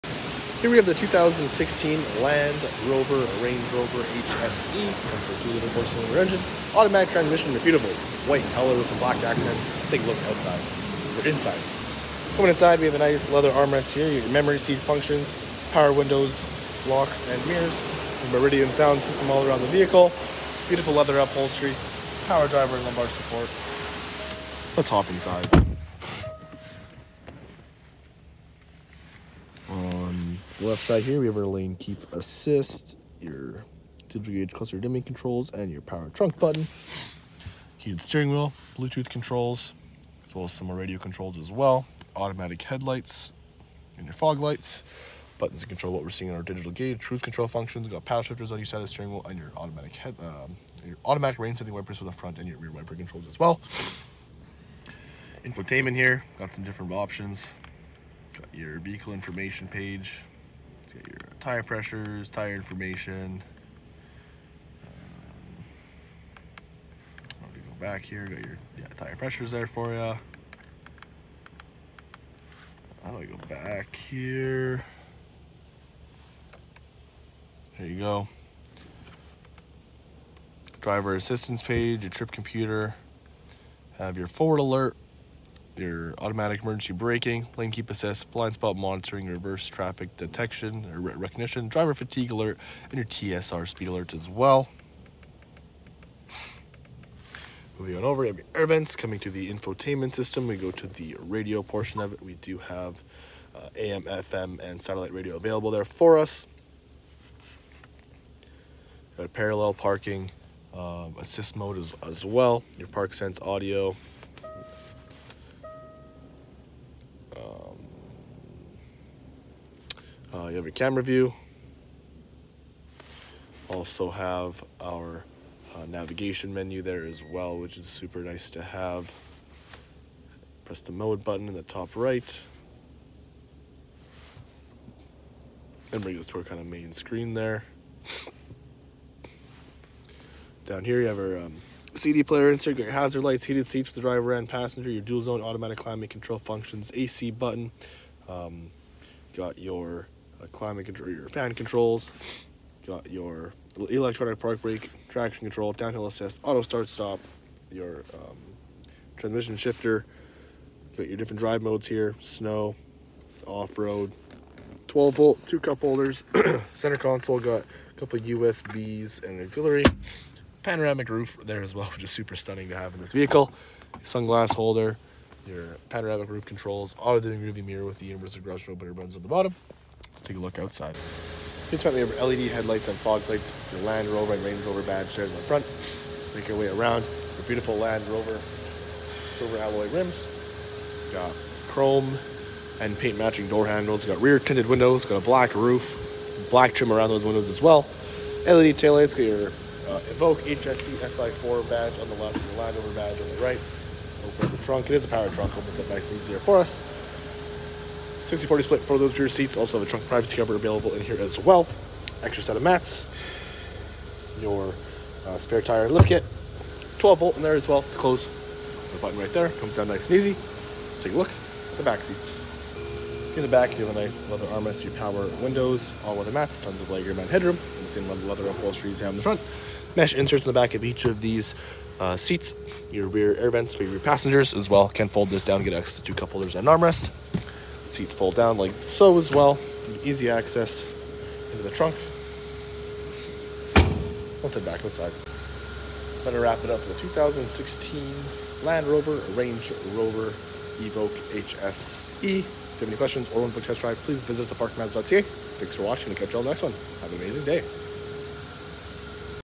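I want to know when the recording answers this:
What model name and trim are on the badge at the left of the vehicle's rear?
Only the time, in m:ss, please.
3:20.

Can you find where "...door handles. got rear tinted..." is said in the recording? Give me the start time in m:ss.
3:13.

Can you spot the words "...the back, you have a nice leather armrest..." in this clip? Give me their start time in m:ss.
3:43.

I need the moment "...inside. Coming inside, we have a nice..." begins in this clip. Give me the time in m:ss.
0:11.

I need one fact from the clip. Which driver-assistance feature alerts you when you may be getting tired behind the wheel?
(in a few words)
Driver fatigue alert.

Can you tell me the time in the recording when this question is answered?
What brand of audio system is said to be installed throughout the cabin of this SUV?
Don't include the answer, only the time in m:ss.
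0:18.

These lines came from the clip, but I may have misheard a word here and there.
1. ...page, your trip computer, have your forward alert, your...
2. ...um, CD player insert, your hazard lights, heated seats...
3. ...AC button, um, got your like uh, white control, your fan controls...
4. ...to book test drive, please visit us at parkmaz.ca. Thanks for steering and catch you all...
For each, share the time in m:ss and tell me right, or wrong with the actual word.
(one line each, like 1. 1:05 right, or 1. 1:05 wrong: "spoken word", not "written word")
1. 1:21 right
2. 2:21 right
3. 2:26 wrong: "climate", not "white"
4. 4:13 wrong: "watching", not "steering".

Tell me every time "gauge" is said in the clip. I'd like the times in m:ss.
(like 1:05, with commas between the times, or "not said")
0:34, 0:46.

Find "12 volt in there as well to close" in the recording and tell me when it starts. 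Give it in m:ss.
3:36.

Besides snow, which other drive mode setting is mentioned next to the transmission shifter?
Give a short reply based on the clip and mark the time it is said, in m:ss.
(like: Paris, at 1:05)
Off-road, at 2:43.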